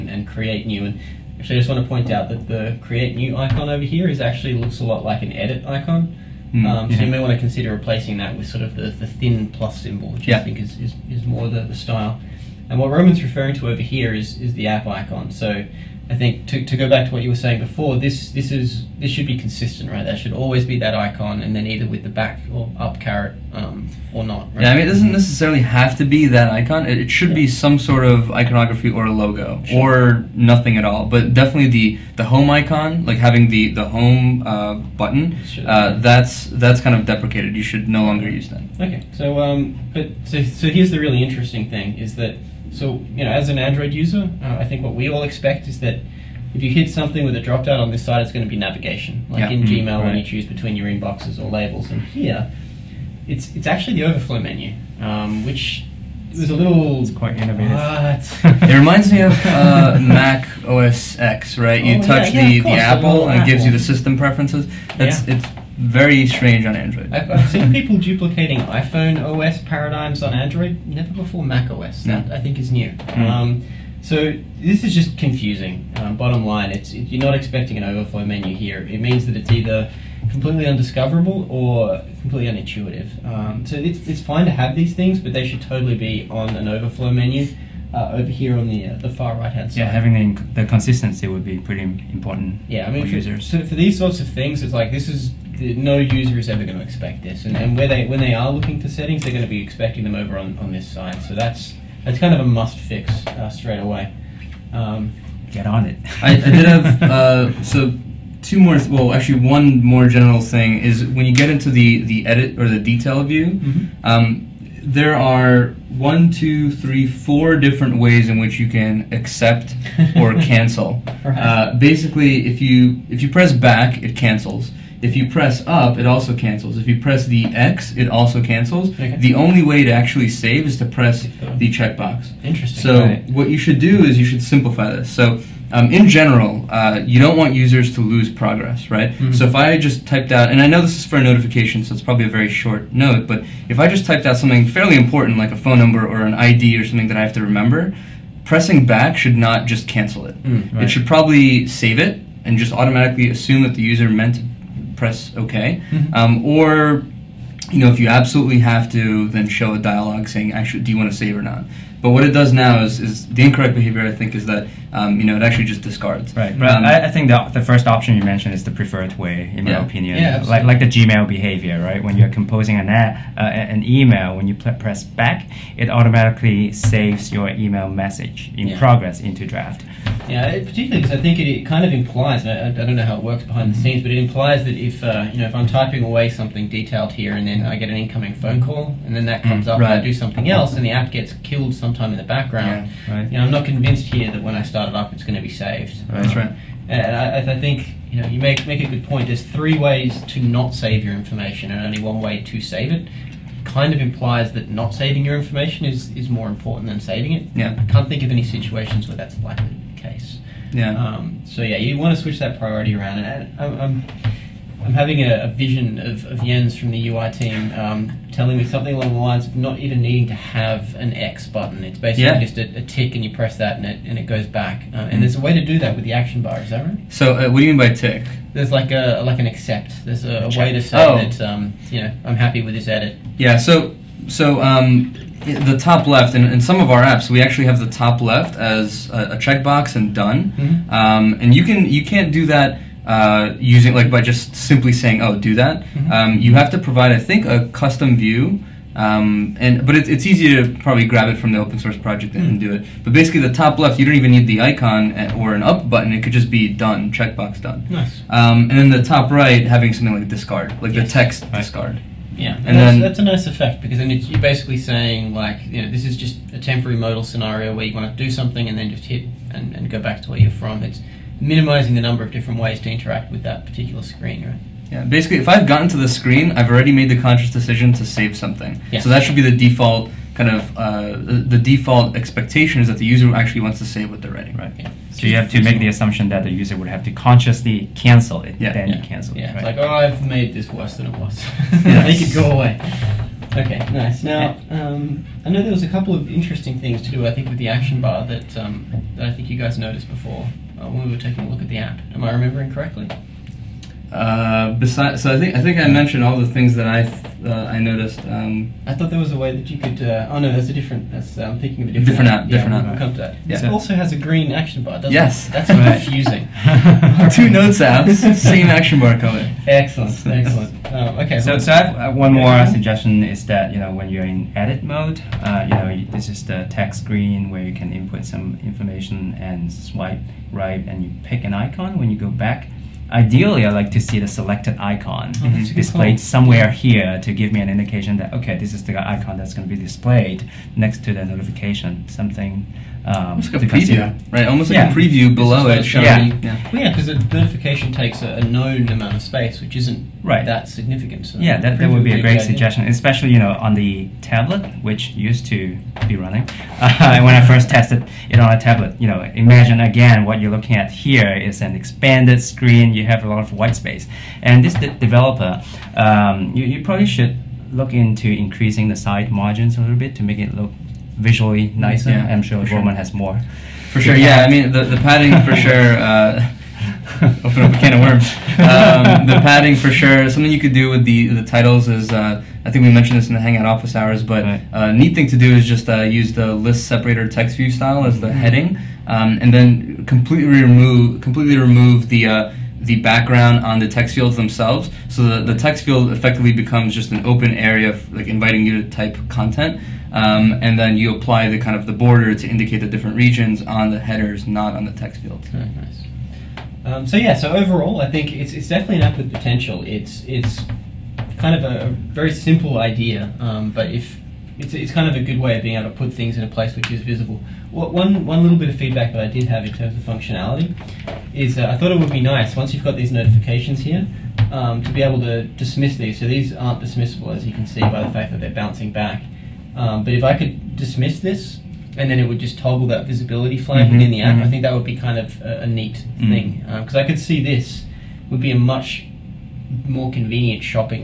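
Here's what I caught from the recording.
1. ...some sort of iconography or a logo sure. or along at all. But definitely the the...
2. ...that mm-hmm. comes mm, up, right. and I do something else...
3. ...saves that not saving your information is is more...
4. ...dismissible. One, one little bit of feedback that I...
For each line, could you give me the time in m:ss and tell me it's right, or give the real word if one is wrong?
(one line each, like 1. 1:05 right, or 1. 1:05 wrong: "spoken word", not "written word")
1. 0:27 wrong: "nothing", not "along"
2. 3:09 right
3. 3:24 wrong: "implies", not "saves"
4. 6:57 wrong: "visible", not "dismissible".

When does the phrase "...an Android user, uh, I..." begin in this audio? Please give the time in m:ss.
0:43.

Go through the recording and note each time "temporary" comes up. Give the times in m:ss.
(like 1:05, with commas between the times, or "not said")
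4:26.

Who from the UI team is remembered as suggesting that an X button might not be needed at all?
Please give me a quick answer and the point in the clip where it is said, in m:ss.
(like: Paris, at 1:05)
Jens, at 3:36.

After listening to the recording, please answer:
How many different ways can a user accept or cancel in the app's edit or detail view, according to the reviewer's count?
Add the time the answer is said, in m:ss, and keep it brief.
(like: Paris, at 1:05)
4, at 1:57.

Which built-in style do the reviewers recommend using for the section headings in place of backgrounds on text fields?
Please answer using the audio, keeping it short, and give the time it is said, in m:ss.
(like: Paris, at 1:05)
list separator text view style, at 6:26.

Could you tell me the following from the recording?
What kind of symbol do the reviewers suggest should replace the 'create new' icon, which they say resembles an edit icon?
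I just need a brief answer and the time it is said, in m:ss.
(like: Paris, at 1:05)
thin plus symbol, at 0:09.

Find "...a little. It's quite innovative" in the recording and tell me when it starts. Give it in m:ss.
0:56.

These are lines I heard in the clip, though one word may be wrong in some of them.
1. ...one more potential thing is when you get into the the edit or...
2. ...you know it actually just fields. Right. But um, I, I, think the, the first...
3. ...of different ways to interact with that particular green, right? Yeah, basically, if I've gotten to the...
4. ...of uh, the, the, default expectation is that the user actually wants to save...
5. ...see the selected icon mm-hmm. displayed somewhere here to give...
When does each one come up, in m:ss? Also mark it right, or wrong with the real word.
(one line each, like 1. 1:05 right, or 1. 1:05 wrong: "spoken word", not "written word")
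1. 1:49 wrong: "general", not "potential"
2. 2:45 wrong: "discards", not "fields"
3. 4:32 wrong: "screen", not "green"
4. 4:40 right
5. 5:34 right.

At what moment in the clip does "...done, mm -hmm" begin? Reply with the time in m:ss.
4:00.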